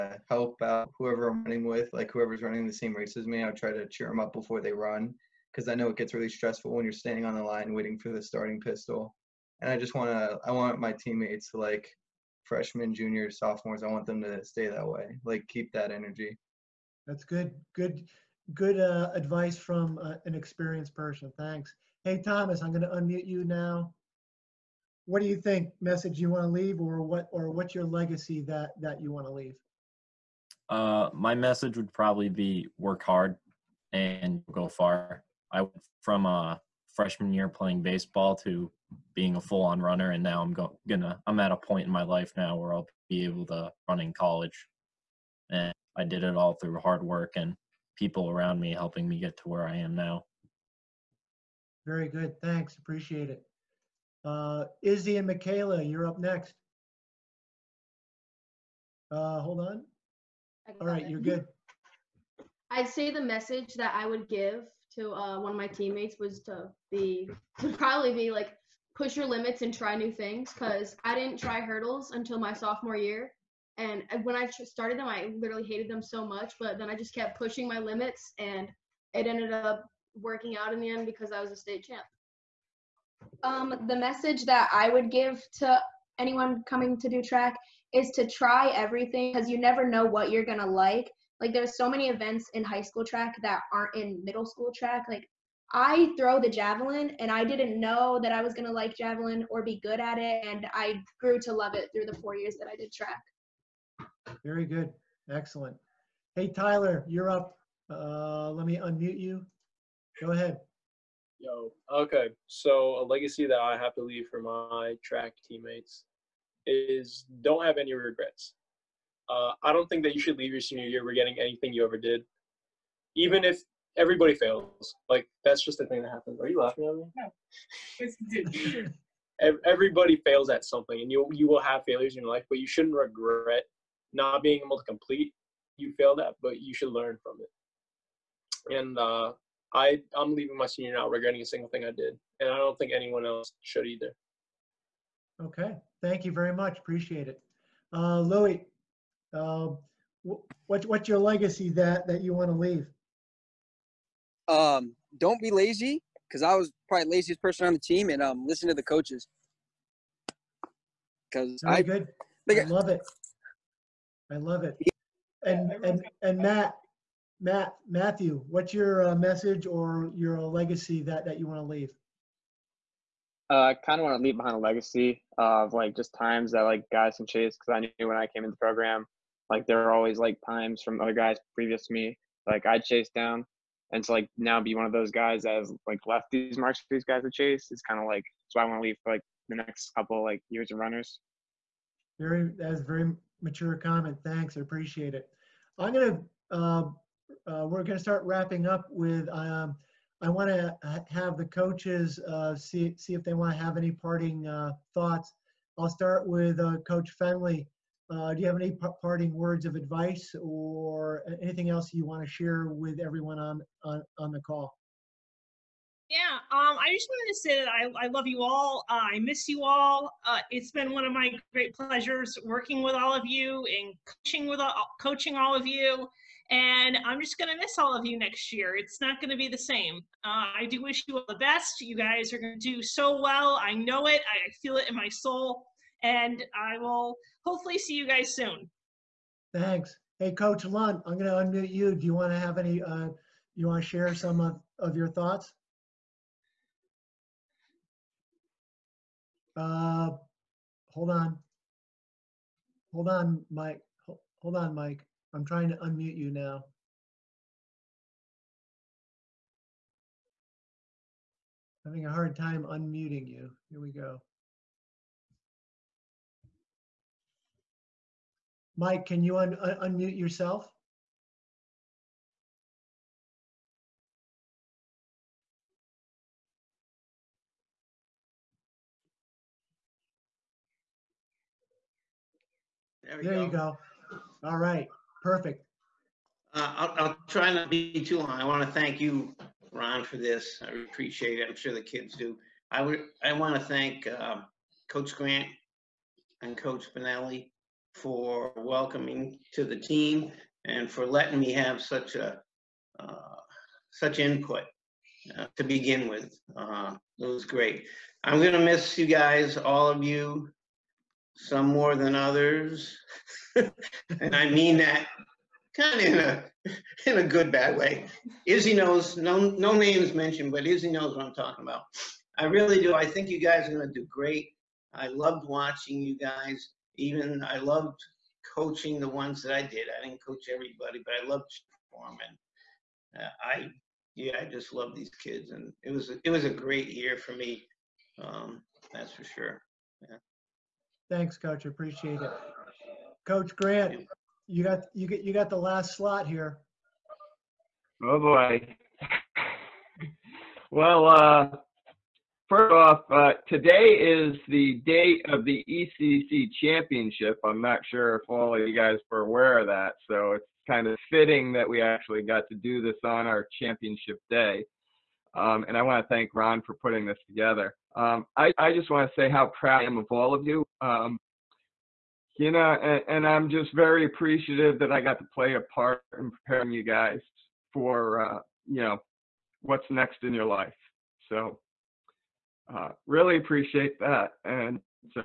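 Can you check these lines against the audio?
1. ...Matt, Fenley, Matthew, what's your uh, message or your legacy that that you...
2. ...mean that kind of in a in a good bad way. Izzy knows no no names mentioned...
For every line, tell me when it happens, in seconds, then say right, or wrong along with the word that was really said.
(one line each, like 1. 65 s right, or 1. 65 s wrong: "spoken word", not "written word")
1. 166 s wrong: "Matt", not "Fenley"
2. 314 s right.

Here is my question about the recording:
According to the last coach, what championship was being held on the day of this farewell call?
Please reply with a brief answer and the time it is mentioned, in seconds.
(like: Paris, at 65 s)
ECC championship, at 355 s.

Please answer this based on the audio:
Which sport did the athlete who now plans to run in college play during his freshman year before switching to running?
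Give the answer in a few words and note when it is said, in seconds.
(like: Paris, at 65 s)
Baseball, at 37 s.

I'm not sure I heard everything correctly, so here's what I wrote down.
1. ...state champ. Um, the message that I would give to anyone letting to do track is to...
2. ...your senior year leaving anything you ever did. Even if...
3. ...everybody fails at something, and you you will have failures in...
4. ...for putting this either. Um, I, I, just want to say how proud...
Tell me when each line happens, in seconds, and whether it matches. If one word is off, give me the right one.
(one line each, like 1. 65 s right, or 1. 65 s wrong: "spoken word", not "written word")
1. 81 s wrong: "coming", not "letting"
2. 120 s wrong: "regretting", not "leaving"
3. 129 s right
4. 366 s wrong: "together", not "either".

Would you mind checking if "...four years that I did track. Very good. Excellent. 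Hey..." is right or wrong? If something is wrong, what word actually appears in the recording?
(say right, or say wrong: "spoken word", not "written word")
right.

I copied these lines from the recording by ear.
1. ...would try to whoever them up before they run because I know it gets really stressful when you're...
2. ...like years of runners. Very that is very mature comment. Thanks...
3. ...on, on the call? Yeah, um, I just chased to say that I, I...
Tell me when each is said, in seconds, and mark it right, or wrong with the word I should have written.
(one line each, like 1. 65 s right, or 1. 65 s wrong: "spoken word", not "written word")
1. 3 s wrong: "cheer", not "whoever"
2. 190 s right
3. 213 s wrong: "wanted", not "chased".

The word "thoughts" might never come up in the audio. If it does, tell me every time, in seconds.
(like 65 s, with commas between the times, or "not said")
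204 s, 245 s.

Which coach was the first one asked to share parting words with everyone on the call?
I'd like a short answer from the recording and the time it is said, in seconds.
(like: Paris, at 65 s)
Coach Fenley, at 206 s.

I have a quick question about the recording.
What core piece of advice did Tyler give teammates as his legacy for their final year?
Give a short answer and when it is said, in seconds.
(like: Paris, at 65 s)
Don't have any regrets, at 117 s.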